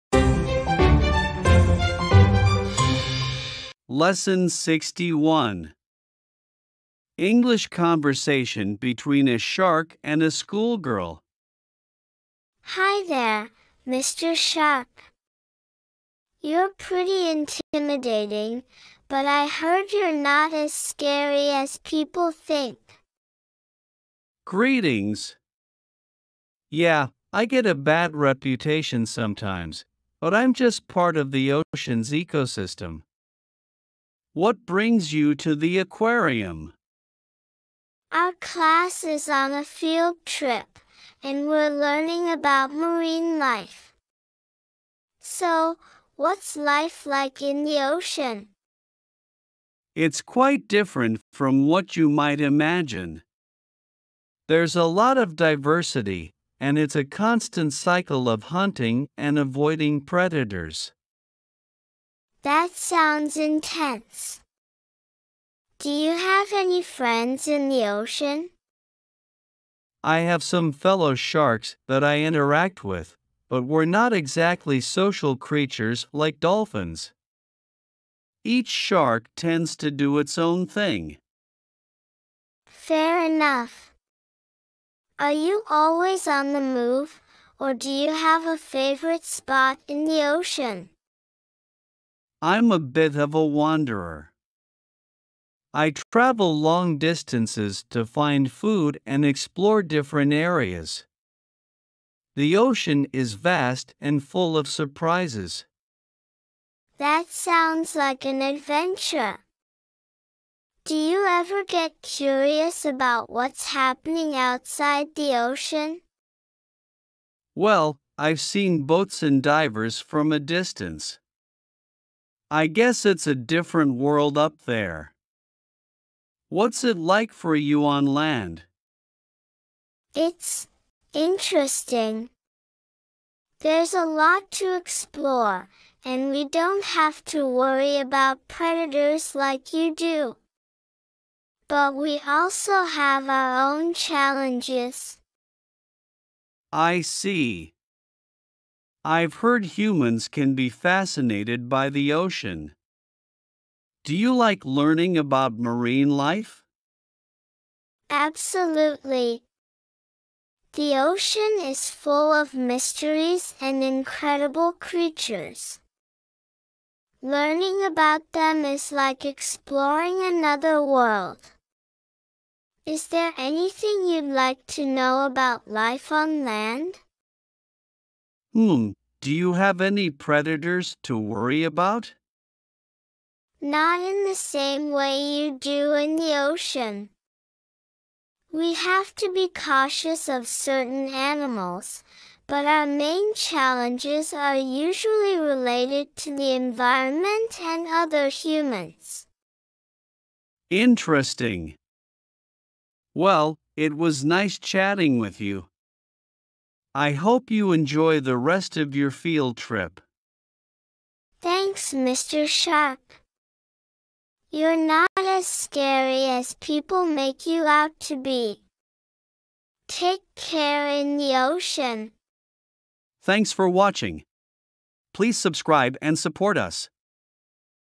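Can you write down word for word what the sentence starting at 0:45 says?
So, what's life like in the ocean?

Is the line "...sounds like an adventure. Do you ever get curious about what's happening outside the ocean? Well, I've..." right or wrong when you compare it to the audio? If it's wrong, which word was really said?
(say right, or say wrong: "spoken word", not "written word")
right.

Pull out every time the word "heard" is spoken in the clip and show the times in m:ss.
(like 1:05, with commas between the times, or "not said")
0:19, 2:29.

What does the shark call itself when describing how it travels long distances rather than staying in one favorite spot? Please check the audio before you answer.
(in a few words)
A wanderer.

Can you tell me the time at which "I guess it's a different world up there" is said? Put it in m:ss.
2:02.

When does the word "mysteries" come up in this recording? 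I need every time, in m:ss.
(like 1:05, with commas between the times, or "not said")
2:42.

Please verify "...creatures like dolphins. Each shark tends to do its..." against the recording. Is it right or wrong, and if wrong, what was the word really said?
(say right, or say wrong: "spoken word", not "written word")
right.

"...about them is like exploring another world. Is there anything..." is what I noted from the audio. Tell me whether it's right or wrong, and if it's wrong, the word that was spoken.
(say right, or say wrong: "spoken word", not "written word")
right.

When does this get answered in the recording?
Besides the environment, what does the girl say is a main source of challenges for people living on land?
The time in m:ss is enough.
3:17.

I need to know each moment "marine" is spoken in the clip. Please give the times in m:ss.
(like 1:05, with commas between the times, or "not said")
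0:42, 2:35.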